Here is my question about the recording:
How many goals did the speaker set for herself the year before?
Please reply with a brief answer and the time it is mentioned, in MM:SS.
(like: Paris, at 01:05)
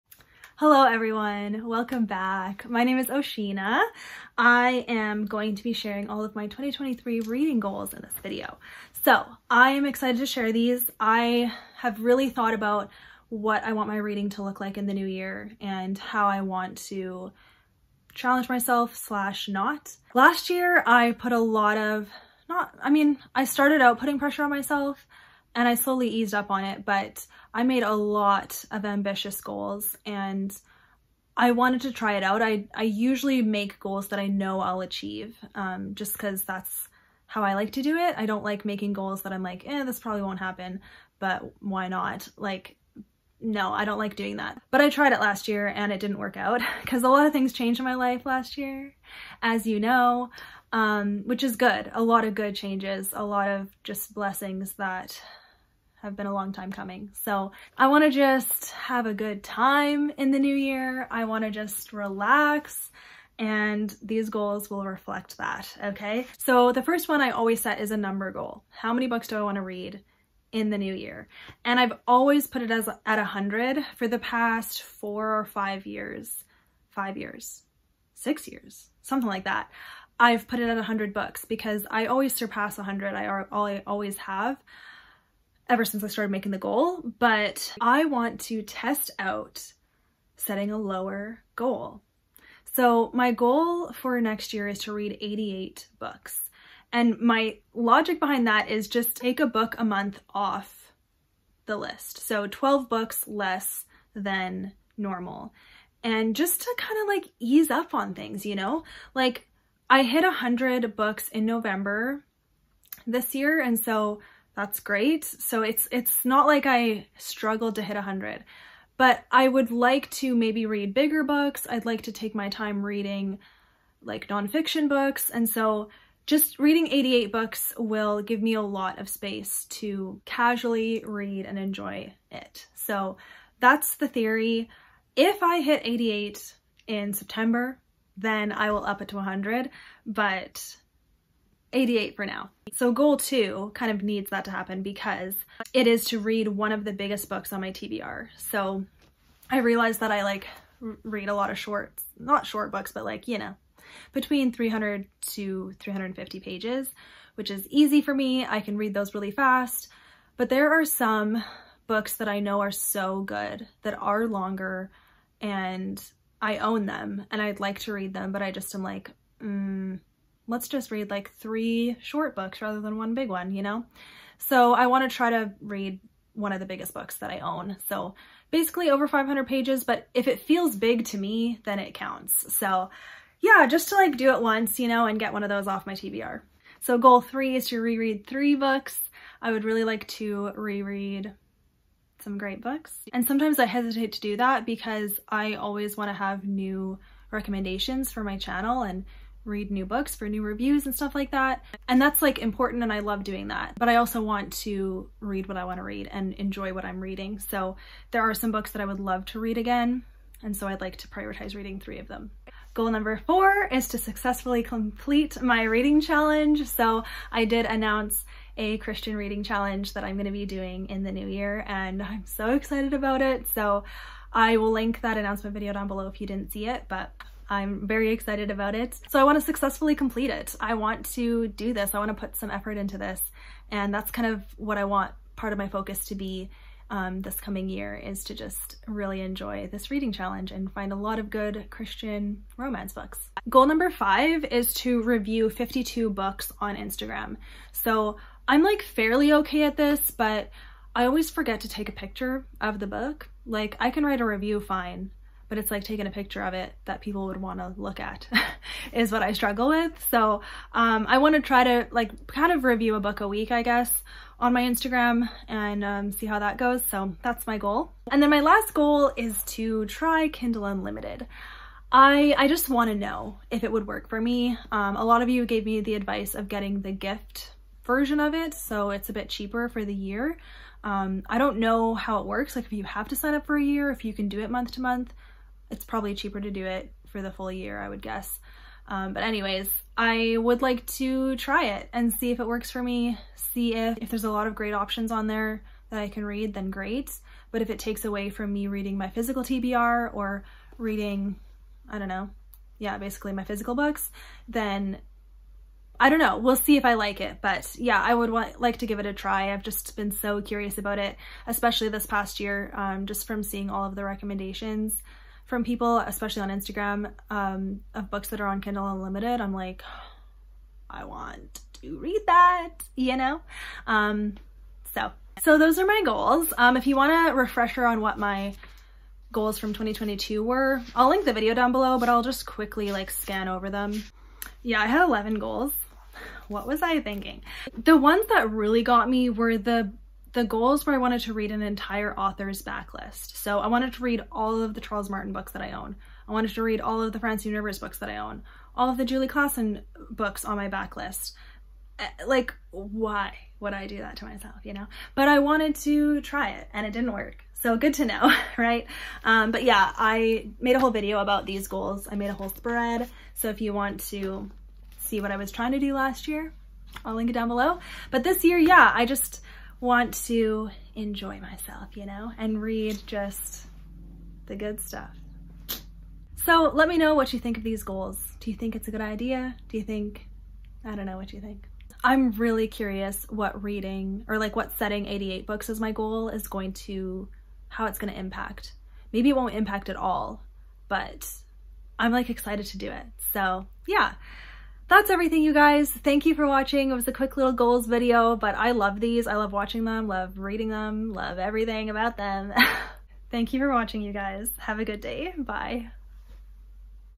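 11, at 05:35.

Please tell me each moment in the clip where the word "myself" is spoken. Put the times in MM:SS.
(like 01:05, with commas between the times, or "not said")
00:18, 00:24, 05:54, 06:11.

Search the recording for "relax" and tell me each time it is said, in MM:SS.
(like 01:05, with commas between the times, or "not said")
01:01.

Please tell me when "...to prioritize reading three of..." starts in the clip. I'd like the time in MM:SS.
03:30.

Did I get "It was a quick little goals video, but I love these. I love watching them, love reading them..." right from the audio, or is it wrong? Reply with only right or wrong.
right.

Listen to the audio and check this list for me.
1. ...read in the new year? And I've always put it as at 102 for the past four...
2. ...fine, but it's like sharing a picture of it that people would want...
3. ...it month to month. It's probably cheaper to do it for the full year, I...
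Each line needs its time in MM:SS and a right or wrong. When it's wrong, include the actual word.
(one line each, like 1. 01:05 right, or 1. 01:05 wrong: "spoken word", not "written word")
1. 01:09 wrong: "100", not "102"
2. 04:14 wrong: "taking", not "sharing"
3. 04:44 right.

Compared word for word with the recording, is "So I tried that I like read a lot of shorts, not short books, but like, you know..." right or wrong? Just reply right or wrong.
wrong.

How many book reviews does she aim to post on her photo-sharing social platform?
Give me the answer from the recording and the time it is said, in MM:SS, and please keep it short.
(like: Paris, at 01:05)
52, at 04:05.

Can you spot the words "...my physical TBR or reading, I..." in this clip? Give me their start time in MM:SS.
04:58.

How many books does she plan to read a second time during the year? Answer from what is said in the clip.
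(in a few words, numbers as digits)
3.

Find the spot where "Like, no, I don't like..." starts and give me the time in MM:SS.
00:42.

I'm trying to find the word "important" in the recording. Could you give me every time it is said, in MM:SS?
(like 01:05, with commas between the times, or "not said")
03:22.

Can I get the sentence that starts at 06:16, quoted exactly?
So let me know what you think of these goals.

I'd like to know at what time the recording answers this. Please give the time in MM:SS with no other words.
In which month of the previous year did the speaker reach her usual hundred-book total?
01:51.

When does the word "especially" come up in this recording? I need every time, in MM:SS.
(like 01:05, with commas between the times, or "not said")
05:11, 05:15.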